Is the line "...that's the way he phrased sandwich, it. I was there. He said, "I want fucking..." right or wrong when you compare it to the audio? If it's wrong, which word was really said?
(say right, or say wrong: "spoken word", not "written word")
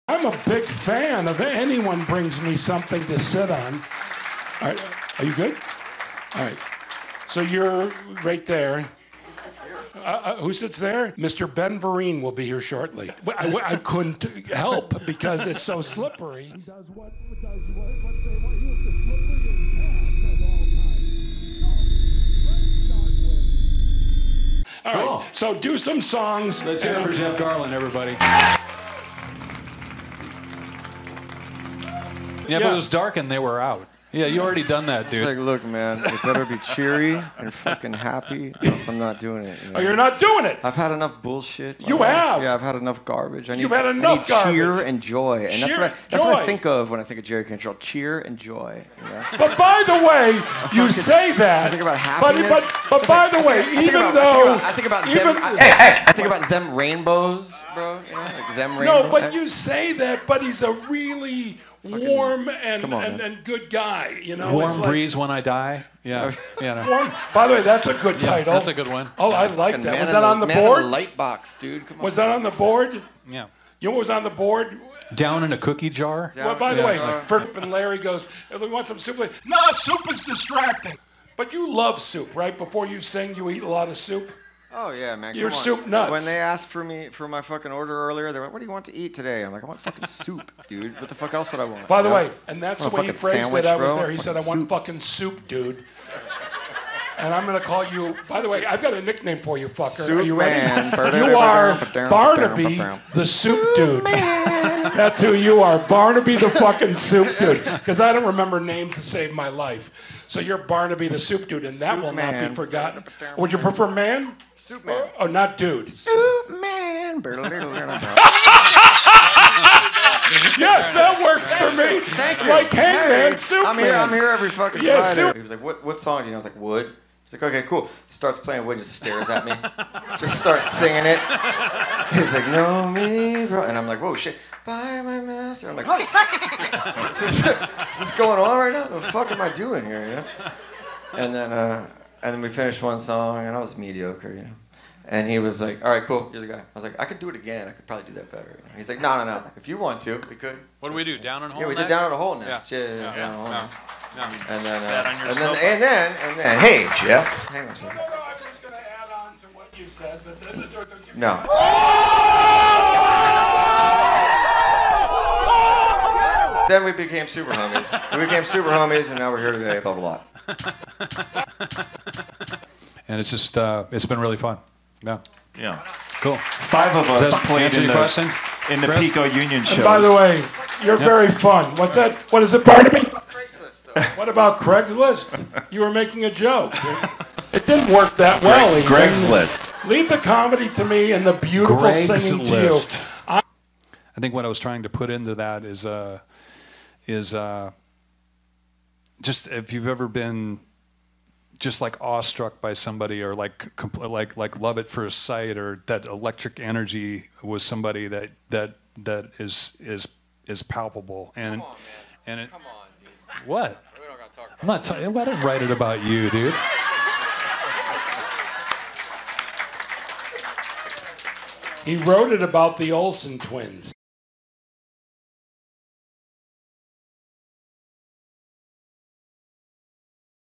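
right.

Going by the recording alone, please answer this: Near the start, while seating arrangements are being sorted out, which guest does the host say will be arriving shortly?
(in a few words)
Ben Vereen.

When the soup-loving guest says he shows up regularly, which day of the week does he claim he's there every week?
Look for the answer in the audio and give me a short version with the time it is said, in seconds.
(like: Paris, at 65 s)
Friday, at 125 s.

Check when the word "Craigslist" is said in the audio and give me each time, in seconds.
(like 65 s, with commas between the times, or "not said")
184 s, 189 s.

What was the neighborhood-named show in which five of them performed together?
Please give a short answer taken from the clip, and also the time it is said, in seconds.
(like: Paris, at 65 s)
Pico Union, at 178 s.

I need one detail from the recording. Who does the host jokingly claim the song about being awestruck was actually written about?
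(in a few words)
The Olsen twins.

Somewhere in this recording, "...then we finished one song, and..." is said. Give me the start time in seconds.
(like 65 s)
142 s.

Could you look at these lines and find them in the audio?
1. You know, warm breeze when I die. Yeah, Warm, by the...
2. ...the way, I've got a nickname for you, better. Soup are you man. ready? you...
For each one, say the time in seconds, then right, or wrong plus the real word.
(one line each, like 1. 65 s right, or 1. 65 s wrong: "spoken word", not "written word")
1. 64 s right
2. 98 s wrong: "fucker", not "better".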